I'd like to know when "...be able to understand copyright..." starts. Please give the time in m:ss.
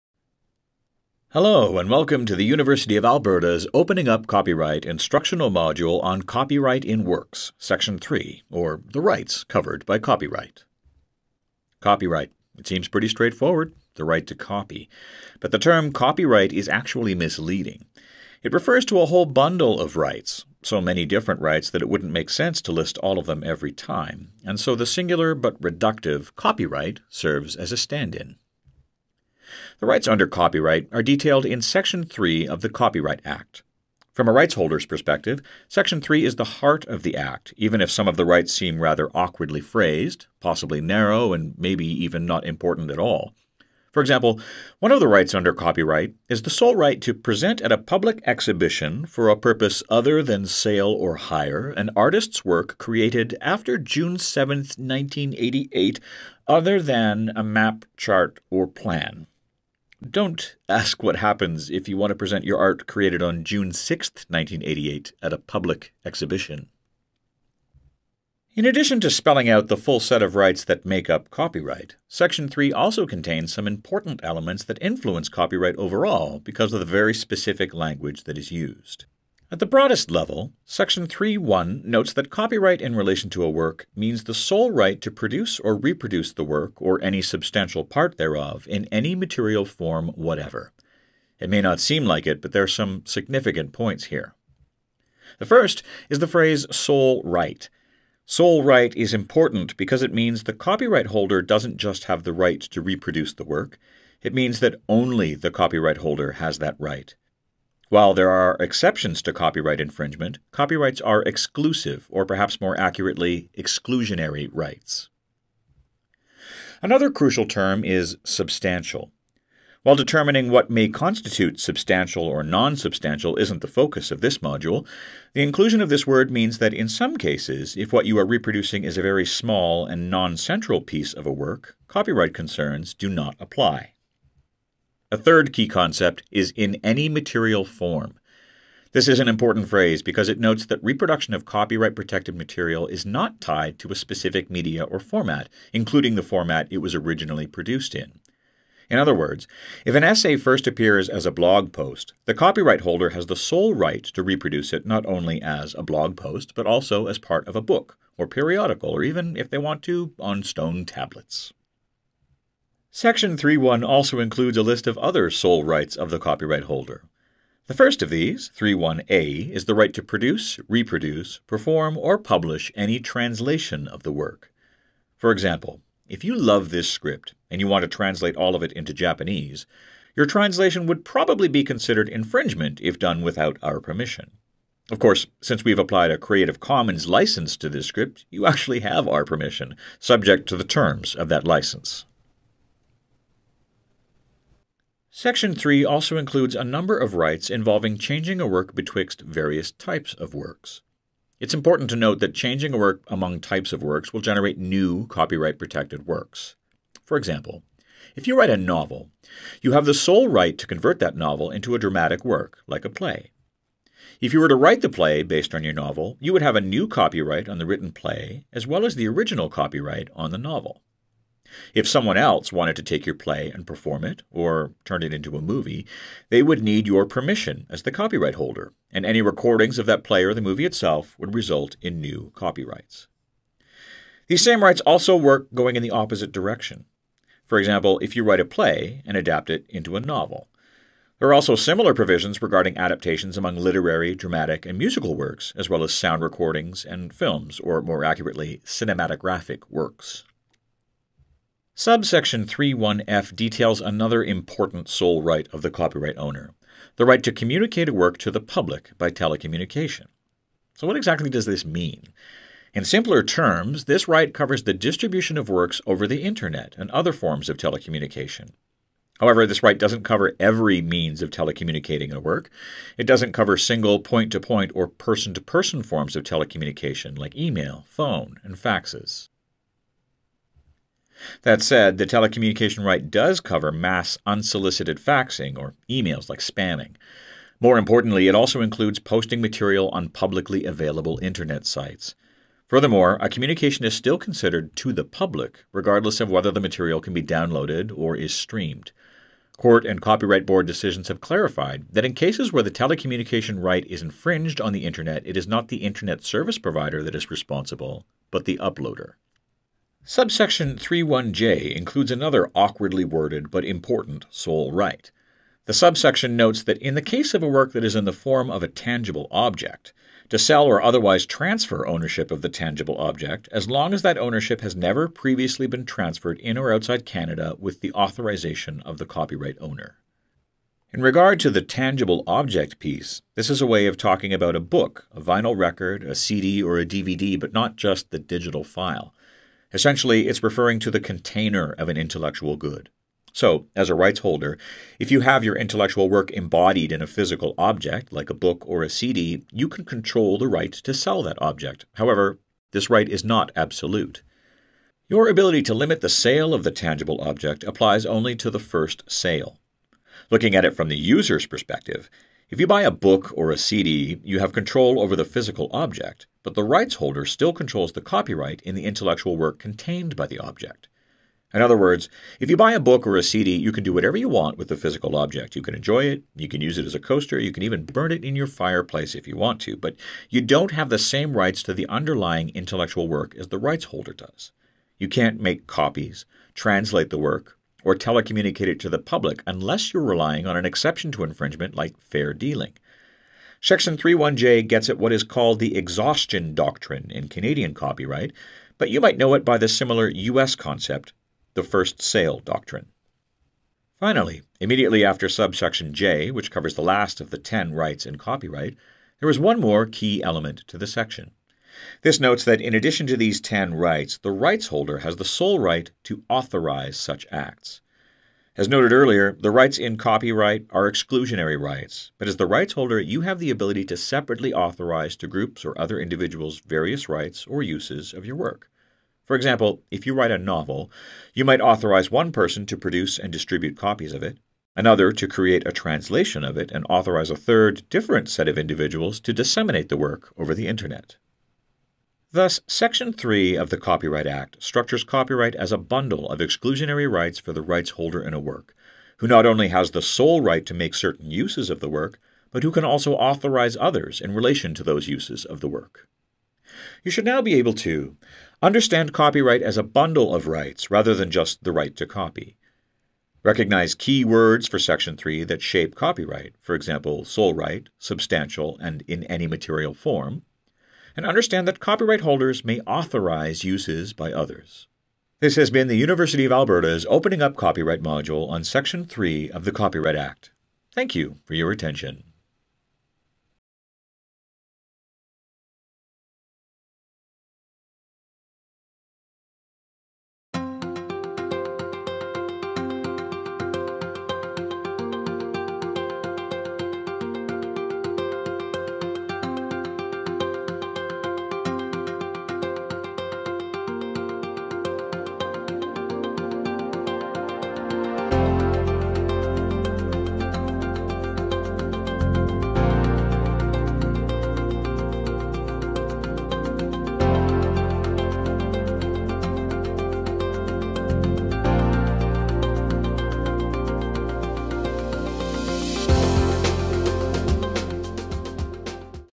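7:37.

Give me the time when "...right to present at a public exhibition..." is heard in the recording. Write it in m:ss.
0:46.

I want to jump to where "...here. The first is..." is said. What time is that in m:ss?
1:34.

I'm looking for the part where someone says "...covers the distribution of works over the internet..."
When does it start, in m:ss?
4:24.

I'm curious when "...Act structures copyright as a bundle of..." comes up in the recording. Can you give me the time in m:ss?
7:24.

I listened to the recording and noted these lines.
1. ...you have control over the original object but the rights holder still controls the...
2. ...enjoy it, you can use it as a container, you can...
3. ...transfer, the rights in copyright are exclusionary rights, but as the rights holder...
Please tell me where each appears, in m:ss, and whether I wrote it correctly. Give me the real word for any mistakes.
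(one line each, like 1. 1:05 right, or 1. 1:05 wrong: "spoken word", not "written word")
1. 6:04 wrong: "physical", not "original"
2. 6:15 wrong: "coaster", not "container"
3. 6:58 wrong: "earlier", not "transfer".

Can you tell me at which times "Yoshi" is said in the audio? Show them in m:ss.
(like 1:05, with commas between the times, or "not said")
not said.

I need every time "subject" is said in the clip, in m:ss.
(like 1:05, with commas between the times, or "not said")
3:09.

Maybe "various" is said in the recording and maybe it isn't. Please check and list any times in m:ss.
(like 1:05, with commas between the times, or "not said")
3:19, 7:06.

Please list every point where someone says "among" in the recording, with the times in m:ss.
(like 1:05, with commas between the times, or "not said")
3:23, 4:03.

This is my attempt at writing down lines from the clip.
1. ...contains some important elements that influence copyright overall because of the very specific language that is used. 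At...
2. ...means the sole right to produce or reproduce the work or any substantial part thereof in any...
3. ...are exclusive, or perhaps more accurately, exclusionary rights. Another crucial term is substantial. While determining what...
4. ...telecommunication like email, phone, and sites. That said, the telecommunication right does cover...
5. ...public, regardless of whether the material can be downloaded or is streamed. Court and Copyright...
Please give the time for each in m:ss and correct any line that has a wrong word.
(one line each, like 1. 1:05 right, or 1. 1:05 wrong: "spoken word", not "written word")
1. 1:13 right
2. 1:23 right
3. 1:51 right
4. 4:36 wrong: "faxes", not "sites"
5. 4:55 right.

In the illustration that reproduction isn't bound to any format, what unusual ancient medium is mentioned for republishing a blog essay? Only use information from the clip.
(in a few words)
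stone tablets.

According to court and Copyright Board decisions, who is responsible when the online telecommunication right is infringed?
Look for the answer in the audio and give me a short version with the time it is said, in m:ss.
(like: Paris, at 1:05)
the uploader, at 5:08.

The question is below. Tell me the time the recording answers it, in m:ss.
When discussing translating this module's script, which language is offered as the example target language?
2:58.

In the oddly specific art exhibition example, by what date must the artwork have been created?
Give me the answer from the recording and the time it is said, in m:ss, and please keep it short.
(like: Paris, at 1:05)
June 7, 1988, at 0:53.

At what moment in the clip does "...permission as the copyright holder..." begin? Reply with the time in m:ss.
3:47.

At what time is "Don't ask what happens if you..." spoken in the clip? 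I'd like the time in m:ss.
1:00.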